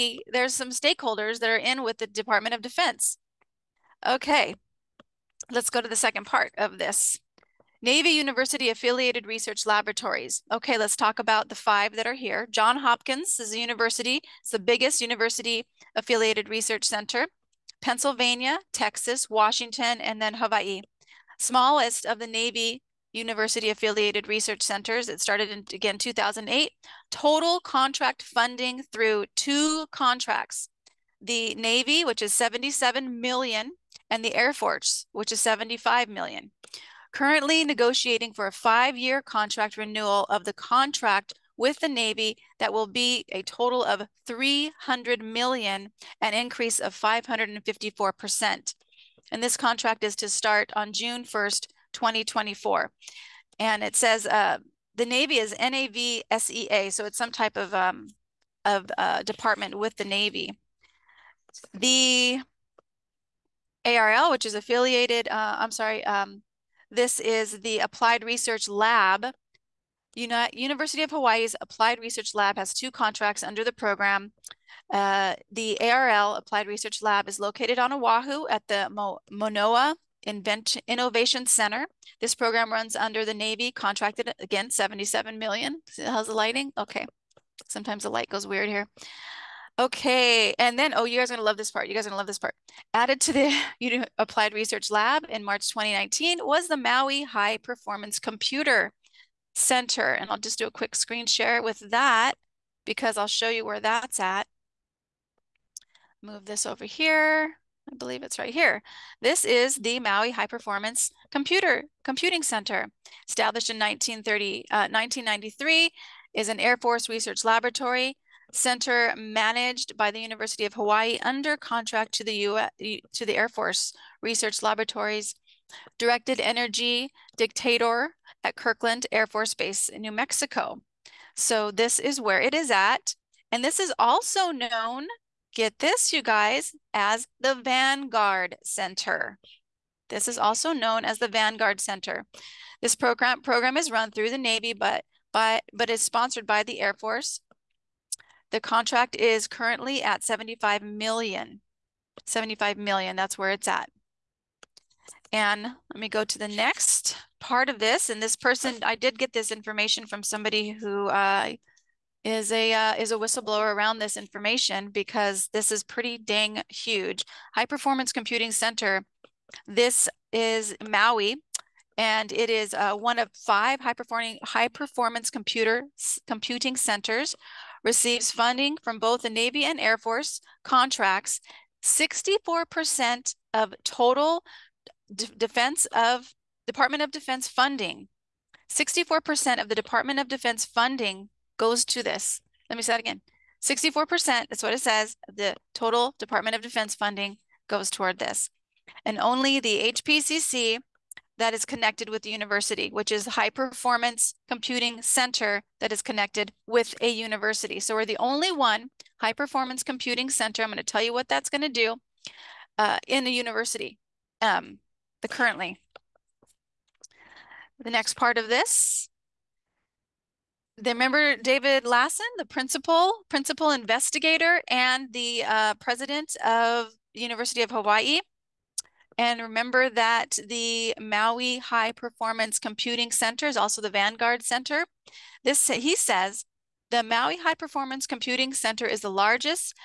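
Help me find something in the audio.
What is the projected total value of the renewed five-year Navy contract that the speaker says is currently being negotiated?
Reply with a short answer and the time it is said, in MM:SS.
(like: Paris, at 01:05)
300 million, at 00:44.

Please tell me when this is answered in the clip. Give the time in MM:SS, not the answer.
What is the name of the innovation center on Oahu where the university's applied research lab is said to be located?
01:18.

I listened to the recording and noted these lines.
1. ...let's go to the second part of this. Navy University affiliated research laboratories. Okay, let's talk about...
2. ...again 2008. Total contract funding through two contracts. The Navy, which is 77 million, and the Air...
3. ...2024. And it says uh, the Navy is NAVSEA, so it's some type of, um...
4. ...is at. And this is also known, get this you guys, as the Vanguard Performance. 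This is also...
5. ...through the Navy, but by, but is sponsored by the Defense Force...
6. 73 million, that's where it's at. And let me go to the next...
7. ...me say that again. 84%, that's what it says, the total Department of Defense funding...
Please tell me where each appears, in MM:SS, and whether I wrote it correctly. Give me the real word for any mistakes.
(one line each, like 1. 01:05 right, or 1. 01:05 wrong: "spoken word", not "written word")
1. 00:05 right
2. 00:25 right
3. 00:51 right
4. 02:12 wrong: "Center", not "Performance"
5. 02:24 wrong: "Air", not "Defense"
6. 02:32 wrong: "75", not "73"
7. 03:12 wrong: "64", not "84".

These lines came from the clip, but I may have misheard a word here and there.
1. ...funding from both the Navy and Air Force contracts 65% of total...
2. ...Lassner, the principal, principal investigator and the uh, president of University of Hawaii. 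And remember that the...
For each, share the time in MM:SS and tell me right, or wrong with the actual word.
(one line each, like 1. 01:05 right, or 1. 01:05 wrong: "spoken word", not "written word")
1. 02:58 wrong: "64", not "65"
2. 03:41 right.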